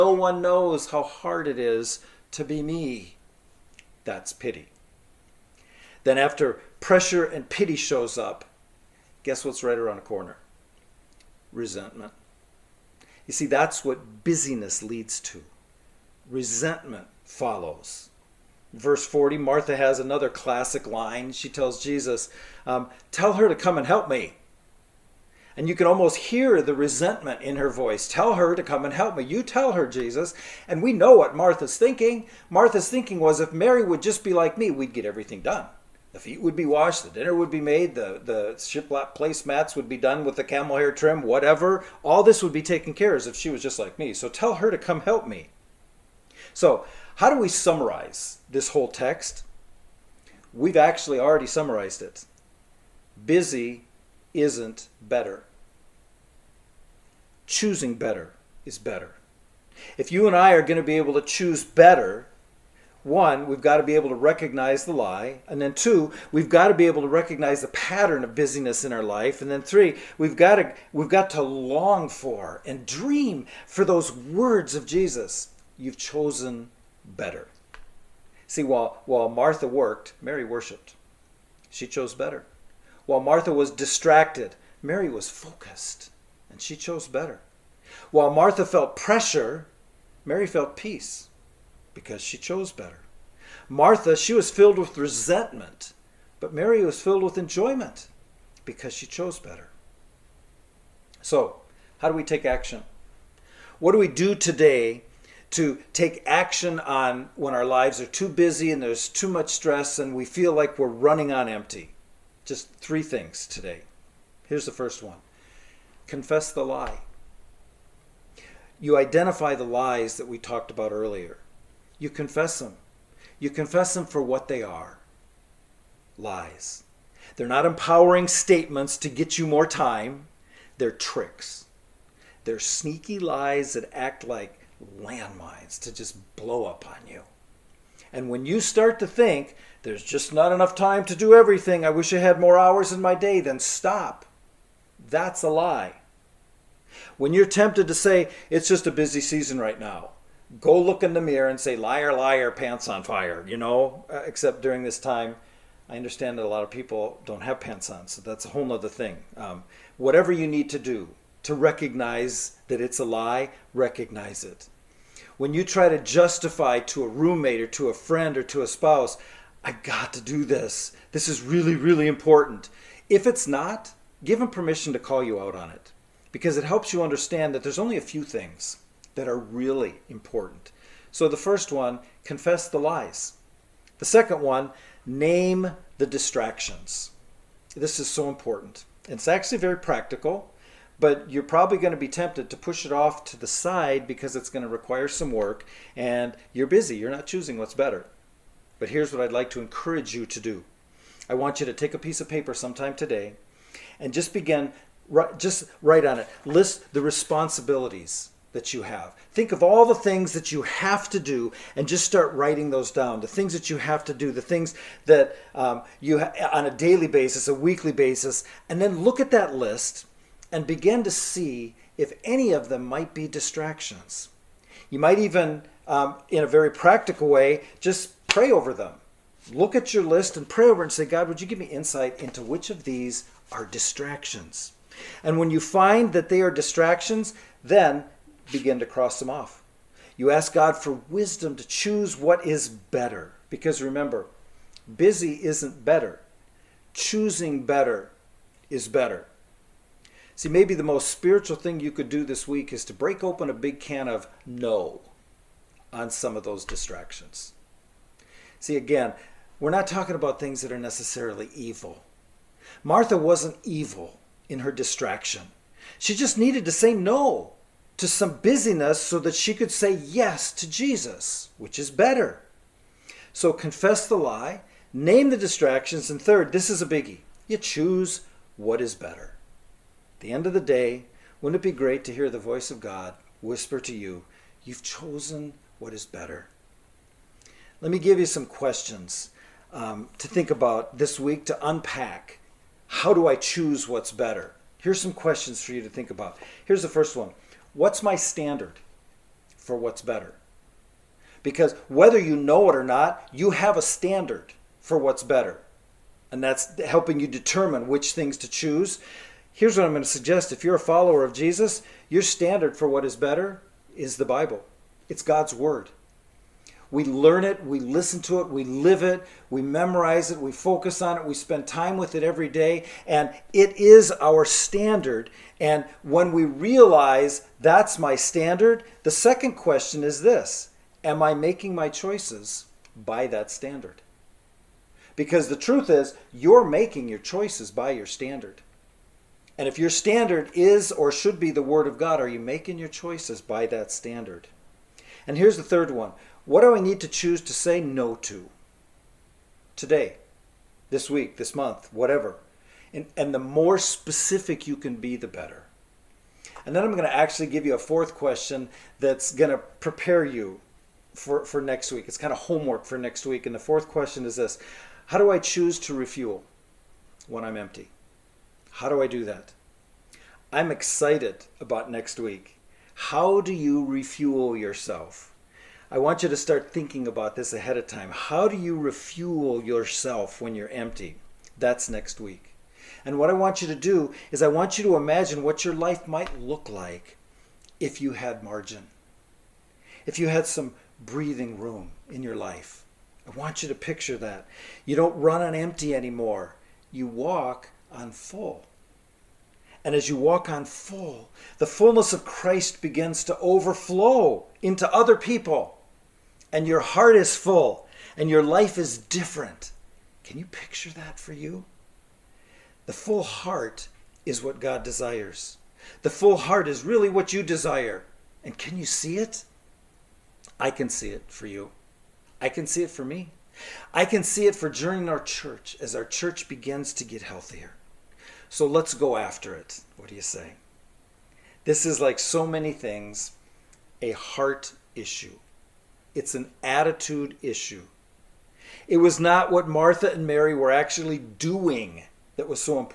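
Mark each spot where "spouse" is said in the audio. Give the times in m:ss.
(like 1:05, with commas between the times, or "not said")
2:48.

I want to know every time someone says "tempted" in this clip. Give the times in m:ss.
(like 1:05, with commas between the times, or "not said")
2:27, 3:12.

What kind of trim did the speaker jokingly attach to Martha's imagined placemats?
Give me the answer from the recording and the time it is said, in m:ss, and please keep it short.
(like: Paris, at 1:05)
camel hair, at 0:40.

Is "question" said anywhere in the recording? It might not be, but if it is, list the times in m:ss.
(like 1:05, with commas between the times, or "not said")
4:48, 4:55, 5:29, 5:58, 6:03.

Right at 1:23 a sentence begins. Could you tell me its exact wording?
While Martha was distracted, Mary was focused, and she chose better.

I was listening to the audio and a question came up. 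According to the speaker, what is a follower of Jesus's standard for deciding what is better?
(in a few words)
the Bible.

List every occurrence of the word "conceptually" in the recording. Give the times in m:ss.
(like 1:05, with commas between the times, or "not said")
not said.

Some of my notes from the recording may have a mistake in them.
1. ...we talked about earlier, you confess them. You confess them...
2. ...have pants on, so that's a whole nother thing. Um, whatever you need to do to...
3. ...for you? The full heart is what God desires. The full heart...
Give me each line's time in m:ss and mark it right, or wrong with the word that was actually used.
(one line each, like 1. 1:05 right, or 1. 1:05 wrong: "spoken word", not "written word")
1. 2:00 right
2. 2:37 right
3. 6:51 right.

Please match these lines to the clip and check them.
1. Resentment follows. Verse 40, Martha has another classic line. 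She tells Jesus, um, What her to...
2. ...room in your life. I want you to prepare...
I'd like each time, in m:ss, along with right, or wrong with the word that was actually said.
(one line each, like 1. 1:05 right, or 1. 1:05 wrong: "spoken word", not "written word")
1. 0:16 wrong: "Tell", not "What"
2. 6:31 wrong: "picture", not "prepare".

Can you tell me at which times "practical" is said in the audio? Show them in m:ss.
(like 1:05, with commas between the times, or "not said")
3:09, 3:46.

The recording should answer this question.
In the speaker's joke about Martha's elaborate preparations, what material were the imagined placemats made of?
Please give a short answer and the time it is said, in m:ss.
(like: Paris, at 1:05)
shiplap, at 0:38.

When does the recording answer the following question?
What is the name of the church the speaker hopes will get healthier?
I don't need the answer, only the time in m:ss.
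7:04.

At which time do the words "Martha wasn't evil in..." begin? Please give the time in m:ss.
4:22.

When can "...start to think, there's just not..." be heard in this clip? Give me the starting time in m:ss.
2:18.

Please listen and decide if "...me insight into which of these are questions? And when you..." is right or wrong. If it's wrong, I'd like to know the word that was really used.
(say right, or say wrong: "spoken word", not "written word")
wrong: "distractions", not "questions".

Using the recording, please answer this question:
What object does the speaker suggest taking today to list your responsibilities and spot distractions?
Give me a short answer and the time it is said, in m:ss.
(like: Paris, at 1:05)
a piece of paper, at 3:21.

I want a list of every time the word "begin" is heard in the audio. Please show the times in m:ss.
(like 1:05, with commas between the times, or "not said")
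3:24, 3:40, 3:58, 6:42, 7:06.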